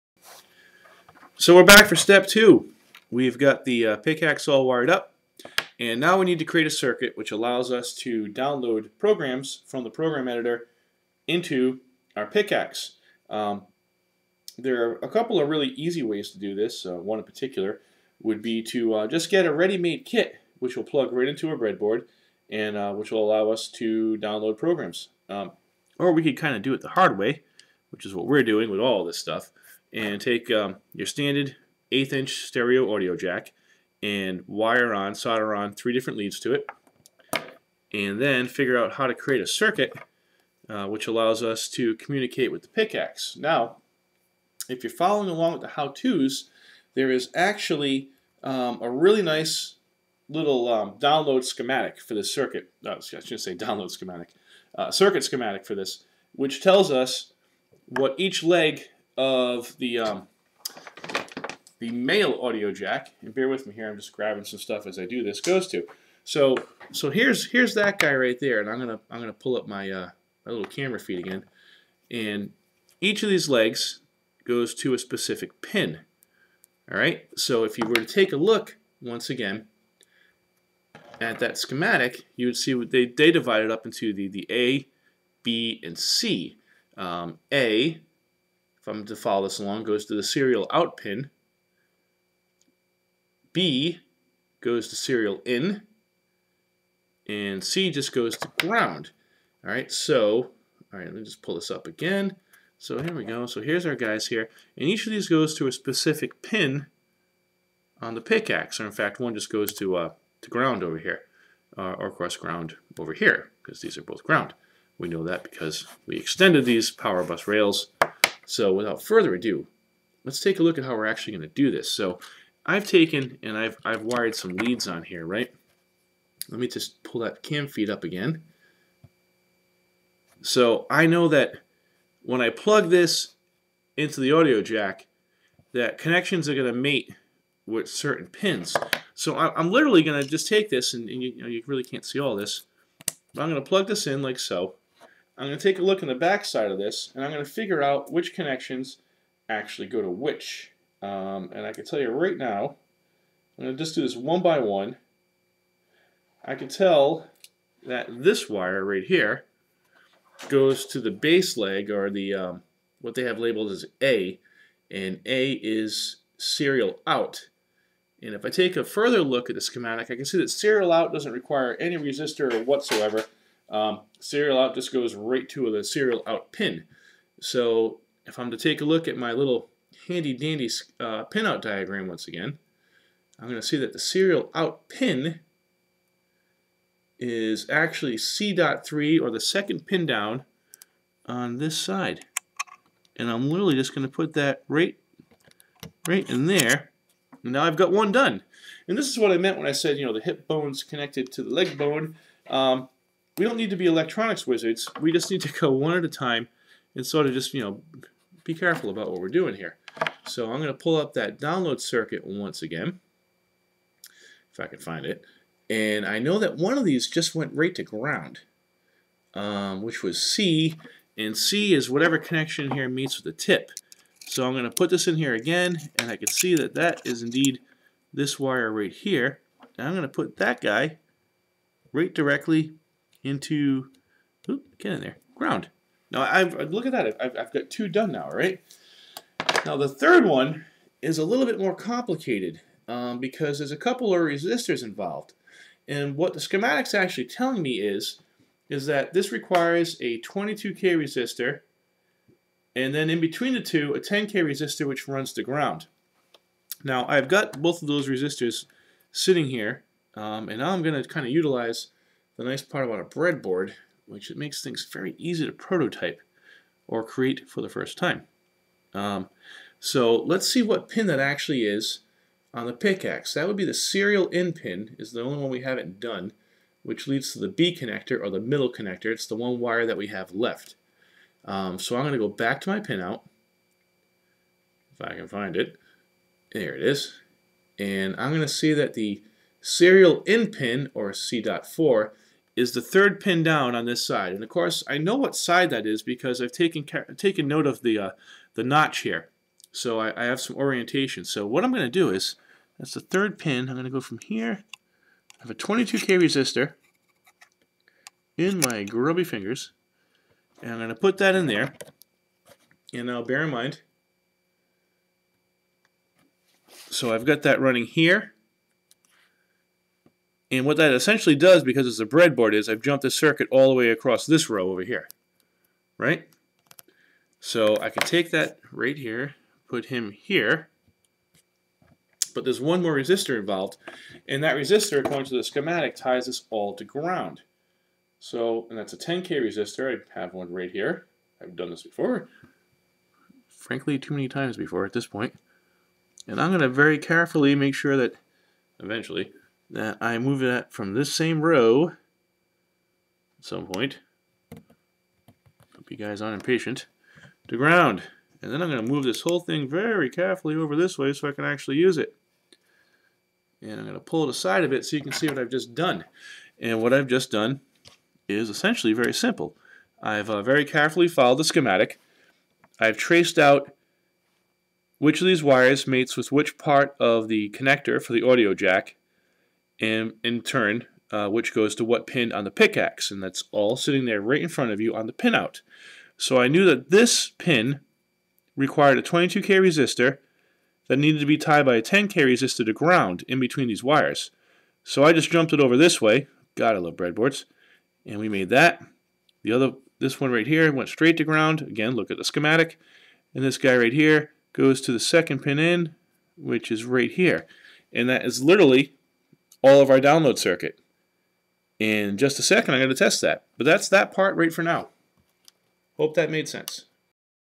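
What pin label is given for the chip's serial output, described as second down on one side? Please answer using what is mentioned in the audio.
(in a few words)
C.3.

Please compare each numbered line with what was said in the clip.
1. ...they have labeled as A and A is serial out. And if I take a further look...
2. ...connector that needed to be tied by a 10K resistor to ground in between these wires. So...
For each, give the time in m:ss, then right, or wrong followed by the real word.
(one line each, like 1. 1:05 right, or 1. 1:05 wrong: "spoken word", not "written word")
1. 2:43 right
2. 6:29 wrong: "resistor", not "connector".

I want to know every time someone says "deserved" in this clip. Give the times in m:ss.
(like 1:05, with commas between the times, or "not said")
not said.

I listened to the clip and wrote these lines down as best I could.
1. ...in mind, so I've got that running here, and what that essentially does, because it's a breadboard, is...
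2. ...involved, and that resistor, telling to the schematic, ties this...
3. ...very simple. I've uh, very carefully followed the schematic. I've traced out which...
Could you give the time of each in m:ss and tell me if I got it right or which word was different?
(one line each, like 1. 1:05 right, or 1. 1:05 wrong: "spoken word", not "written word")
1. 5:13 right
2. 5:33 wrong: "according", not "telling"
3. 6:08 right.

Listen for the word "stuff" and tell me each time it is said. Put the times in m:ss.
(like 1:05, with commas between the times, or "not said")
0:29, 1:04.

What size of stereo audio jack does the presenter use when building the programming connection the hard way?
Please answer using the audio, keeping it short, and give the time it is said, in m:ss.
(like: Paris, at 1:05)
eighth inch, at 0:31.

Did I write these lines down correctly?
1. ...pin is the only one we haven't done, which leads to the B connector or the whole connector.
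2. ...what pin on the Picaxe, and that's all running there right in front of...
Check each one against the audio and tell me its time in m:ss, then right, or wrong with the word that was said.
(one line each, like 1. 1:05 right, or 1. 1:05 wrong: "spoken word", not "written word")
1. 4:34 wrong: "middle", not "whole"
2. 6:21 wrong: "sitting", not "running".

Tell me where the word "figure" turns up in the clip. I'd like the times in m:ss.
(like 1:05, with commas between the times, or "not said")
0:38, 2:27.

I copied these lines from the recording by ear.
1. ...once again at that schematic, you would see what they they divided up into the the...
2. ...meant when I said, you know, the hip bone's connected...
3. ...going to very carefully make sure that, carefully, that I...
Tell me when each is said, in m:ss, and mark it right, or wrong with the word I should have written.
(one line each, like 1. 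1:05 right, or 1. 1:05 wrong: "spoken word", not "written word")
1. 1:19 right
2. 3:19 right
3. 5:46 wrong: "eventually", not "carefully".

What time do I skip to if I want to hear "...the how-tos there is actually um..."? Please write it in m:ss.
0:45.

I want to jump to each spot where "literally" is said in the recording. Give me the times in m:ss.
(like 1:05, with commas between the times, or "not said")
2:19, 3:13, 6:48.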